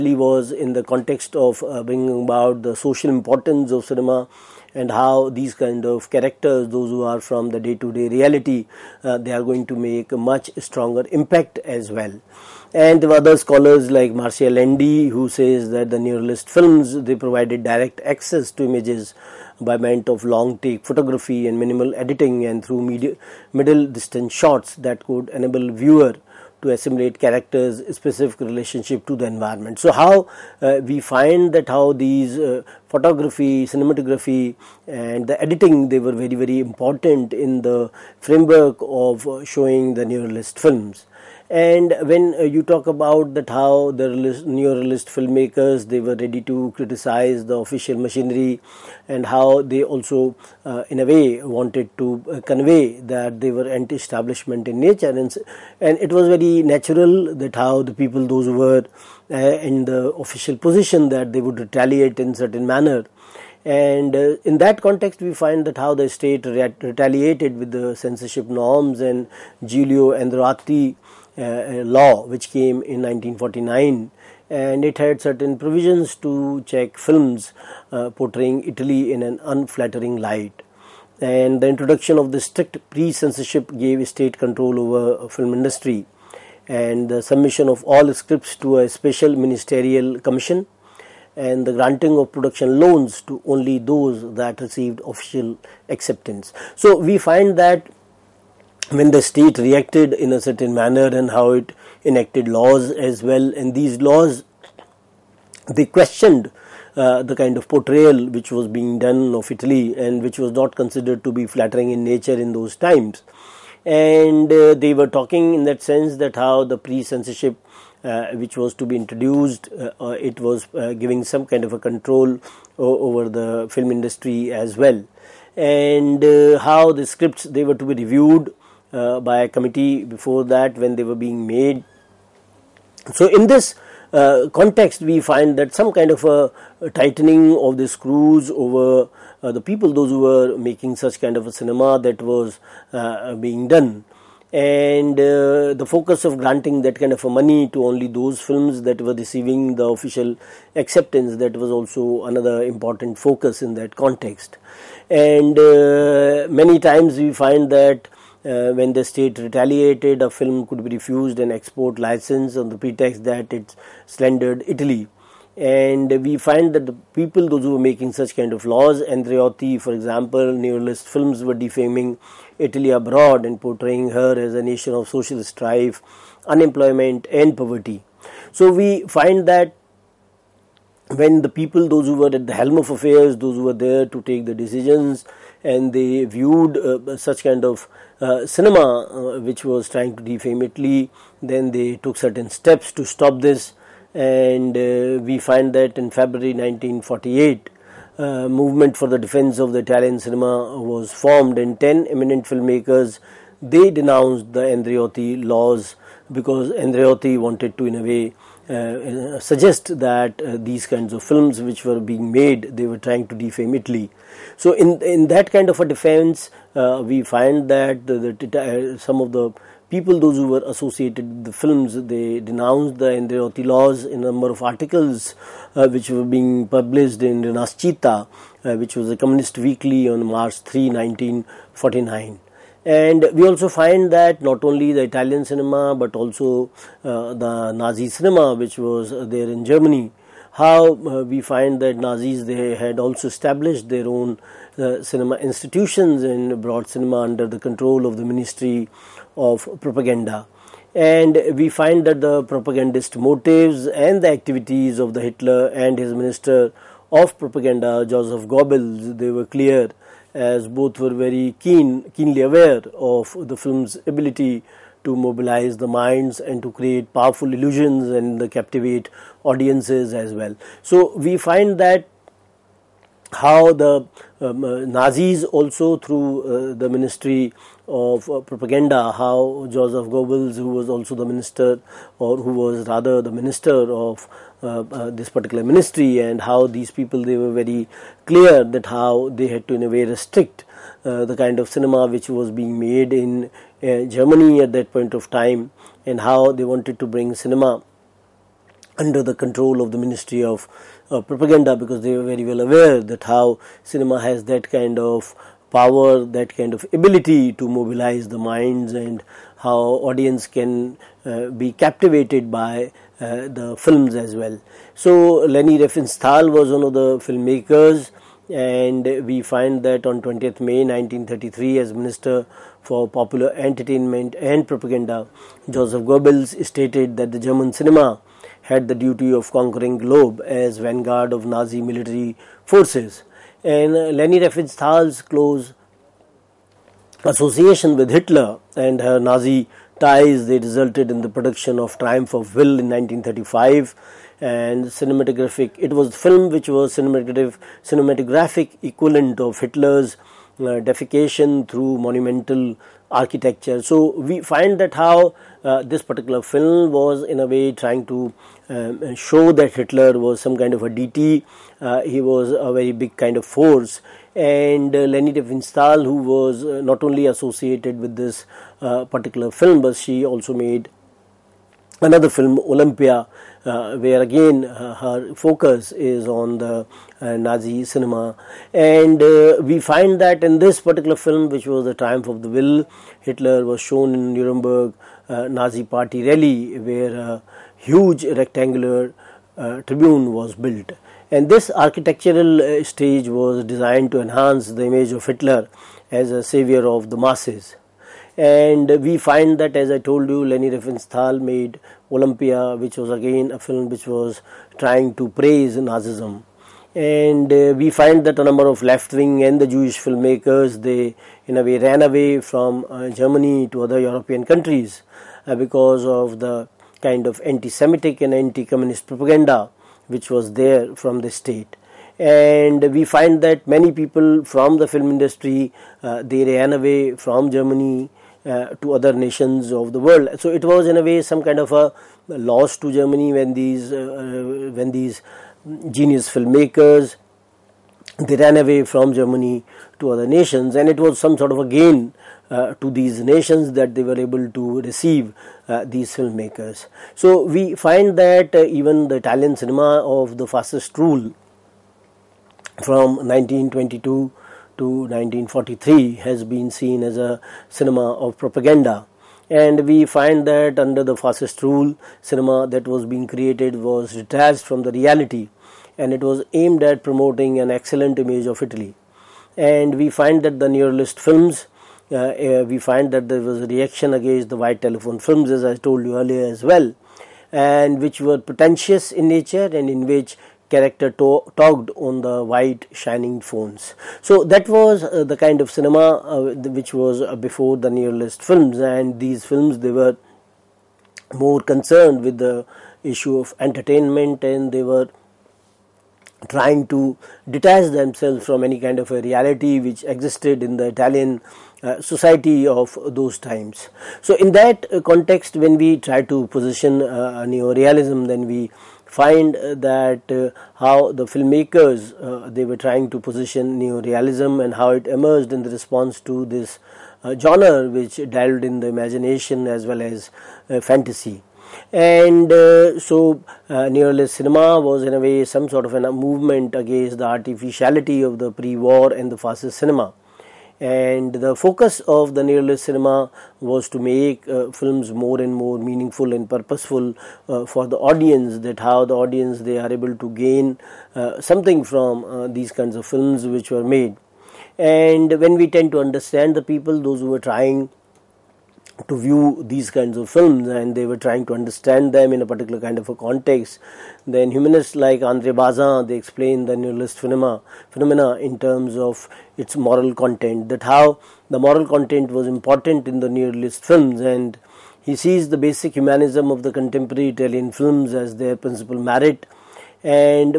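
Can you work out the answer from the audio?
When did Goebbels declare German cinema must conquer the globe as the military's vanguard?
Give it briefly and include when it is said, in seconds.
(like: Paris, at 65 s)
20 May 1933, at 320 s.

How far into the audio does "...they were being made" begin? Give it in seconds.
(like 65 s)
130 s.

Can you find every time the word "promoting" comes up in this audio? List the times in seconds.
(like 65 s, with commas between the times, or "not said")
467 s.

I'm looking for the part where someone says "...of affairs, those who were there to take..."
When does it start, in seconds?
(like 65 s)
182 s.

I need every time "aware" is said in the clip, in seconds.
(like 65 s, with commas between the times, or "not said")
262 s, 302 s.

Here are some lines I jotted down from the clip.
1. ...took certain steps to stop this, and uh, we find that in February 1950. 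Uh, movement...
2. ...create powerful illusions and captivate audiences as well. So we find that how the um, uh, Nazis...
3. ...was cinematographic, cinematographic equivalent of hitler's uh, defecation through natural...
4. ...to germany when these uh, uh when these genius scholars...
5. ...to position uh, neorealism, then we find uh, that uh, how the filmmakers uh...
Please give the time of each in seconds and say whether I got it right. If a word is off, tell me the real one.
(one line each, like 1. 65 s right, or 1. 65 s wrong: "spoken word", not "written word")
1. 191 s wrong: "1948", not "1950"
2. 266 s right
3. 346 s wrong: "monumental", not "natural"
4. 432 s wrong: "filmmakers", not "scholars"
5. 506 s right.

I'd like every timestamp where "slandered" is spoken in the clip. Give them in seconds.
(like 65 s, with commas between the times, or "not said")
164 s.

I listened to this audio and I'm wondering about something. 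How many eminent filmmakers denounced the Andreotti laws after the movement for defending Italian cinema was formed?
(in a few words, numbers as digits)
10.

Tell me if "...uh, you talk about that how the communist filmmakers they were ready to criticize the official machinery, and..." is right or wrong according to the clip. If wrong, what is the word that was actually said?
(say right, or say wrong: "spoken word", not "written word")
wrong: "neorealist", not "communist".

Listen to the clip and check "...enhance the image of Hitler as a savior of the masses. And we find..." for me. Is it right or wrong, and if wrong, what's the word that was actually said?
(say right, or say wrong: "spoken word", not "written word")
right.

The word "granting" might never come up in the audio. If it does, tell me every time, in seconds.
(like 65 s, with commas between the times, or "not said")
91 s, 146 s.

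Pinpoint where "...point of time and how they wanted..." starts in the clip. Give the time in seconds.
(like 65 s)
294 s.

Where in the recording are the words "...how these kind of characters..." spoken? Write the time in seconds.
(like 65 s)
4 s.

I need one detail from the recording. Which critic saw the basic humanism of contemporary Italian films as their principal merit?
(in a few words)
Andre Bazin.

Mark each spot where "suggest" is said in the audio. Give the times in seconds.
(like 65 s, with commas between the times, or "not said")
209 s.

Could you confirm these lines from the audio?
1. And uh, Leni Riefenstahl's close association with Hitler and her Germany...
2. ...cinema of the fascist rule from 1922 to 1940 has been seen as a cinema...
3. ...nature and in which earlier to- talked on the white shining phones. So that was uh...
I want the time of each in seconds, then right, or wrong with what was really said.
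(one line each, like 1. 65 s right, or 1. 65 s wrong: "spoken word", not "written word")
1. 333 s wrong: "Nazi", not "Germany"
2. 449 s wrong: "1943", not "1940"
3. 479 s wrong: "character", not "earlier".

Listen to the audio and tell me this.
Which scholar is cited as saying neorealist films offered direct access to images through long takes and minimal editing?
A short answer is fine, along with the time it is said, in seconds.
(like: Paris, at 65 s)
Marcia Landy, at 14 s.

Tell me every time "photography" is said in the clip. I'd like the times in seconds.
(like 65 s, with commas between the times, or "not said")
20 s, 32 s.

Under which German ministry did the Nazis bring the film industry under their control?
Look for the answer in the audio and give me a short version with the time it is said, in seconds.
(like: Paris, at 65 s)
Ministry of Propaganda, at 248 s.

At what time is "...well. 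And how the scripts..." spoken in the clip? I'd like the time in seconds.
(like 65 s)
124 s.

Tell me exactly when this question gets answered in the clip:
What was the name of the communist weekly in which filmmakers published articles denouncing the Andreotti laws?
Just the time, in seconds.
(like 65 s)
227 s.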